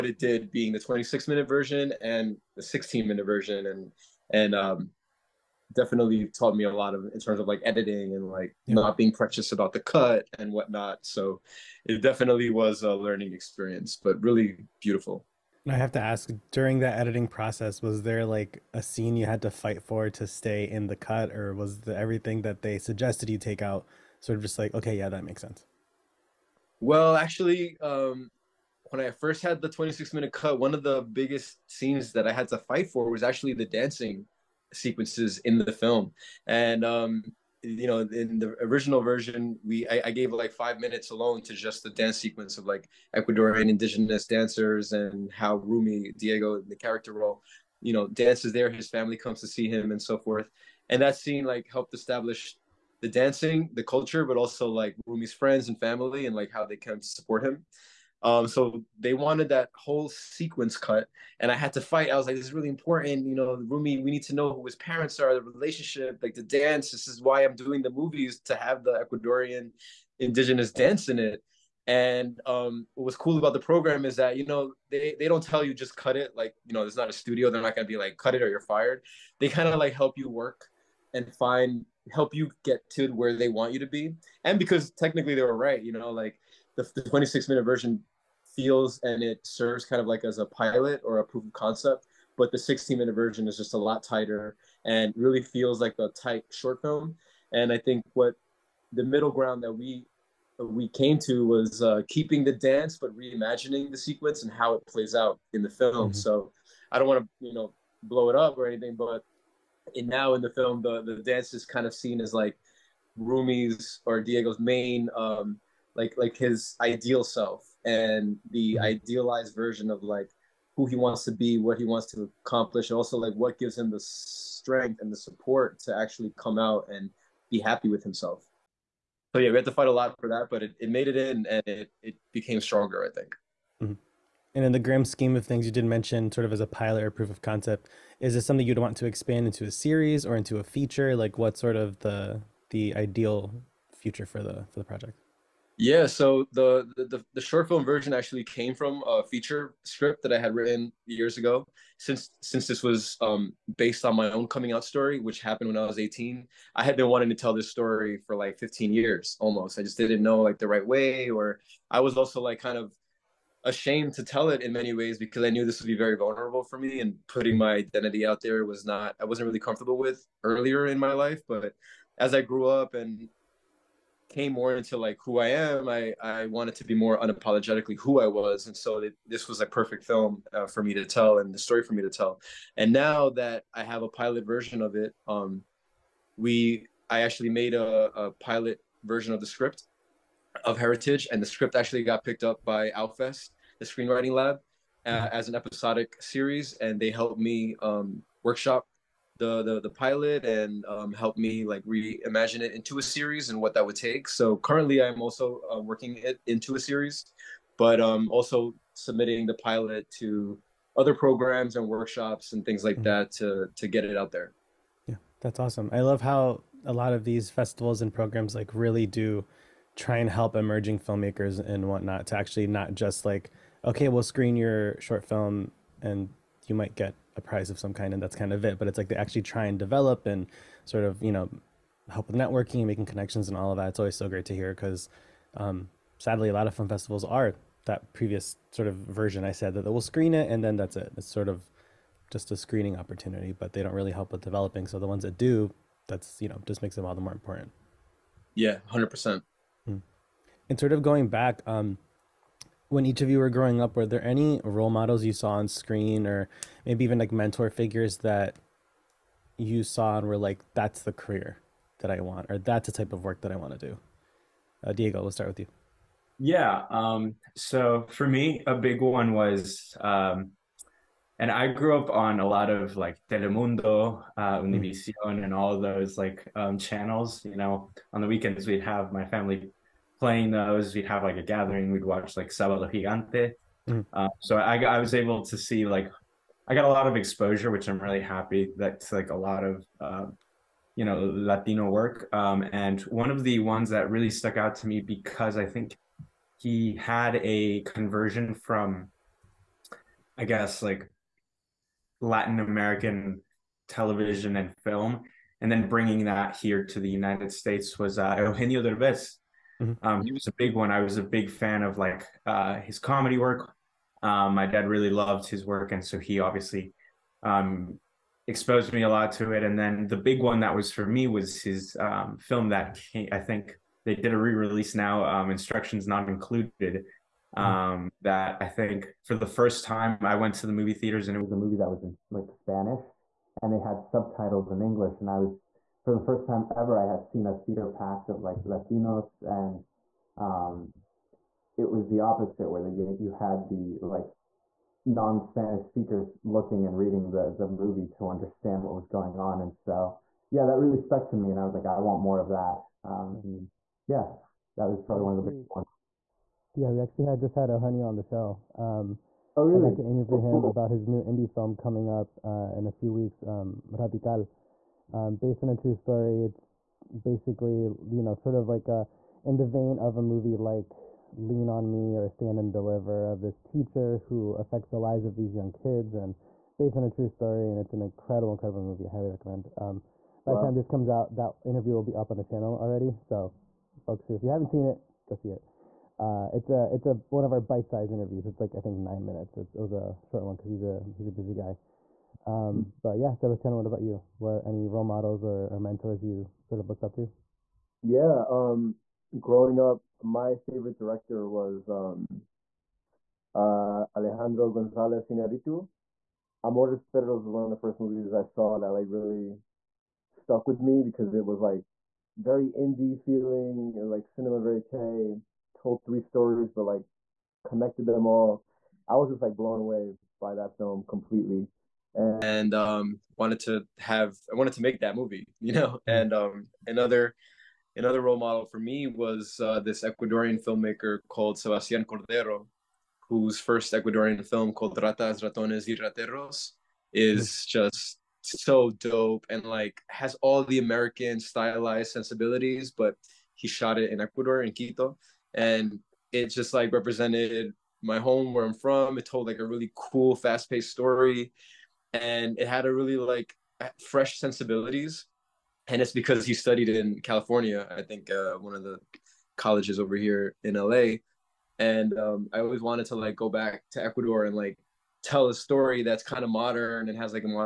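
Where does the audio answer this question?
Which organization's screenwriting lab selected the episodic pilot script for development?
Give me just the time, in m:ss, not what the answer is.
3:12.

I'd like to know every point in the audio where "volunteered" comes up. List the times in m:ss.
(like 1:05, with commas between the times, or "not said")
not said.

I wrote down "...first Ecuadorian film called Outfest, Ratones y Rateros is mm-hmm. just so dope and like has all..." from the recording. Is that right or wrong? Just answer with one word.
wrong.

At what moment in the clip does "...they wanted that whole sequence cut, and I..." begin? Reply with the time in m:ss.
0:58.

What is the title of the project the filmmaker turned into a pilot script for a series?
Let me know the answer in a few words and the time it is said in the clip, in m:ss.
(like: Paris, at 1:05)
Heritage, at 3:10.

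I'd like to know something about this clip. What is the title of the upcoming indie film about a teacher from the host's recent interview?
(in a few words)
Radical.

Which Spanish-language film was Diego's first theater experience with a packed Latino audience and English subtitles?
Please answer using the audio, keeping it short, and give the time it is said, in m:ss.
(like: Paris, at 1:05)
Instructions Not Included, at 5:25.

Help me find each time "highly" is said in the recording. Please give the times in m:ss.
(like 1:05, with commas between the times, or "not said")
6:19.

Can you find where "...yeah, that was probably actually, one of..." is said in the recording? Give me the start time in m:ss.
5:54.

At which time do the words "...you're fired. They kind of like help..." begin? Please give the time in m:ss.
1:18.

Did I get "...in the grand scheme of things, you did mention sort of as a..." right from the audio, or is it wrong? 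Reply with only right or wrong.
right.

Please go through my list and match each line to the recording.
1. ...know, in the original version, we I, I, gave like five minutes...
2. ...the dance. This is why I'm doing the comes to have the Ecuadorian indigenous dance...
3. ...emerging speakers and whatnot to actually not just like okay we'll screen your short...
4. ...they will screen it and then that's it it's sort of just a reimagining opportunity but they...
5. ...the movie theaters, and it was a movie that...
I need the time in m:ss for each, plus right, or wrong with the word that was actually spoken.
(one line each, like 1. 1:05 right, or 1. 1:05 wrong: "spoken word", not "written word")
1. 0:37 right
2. 1:06 wrong: "movies", not "comes"
3. 3:40 wrong: "filmmakers", not "speakers"
4. 3:59 wrong: "screening", not "reimagining"
5. 5:30 right.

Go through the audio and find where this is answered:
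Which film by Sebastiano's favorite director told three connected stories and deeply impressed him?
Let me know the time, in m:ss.
6:46.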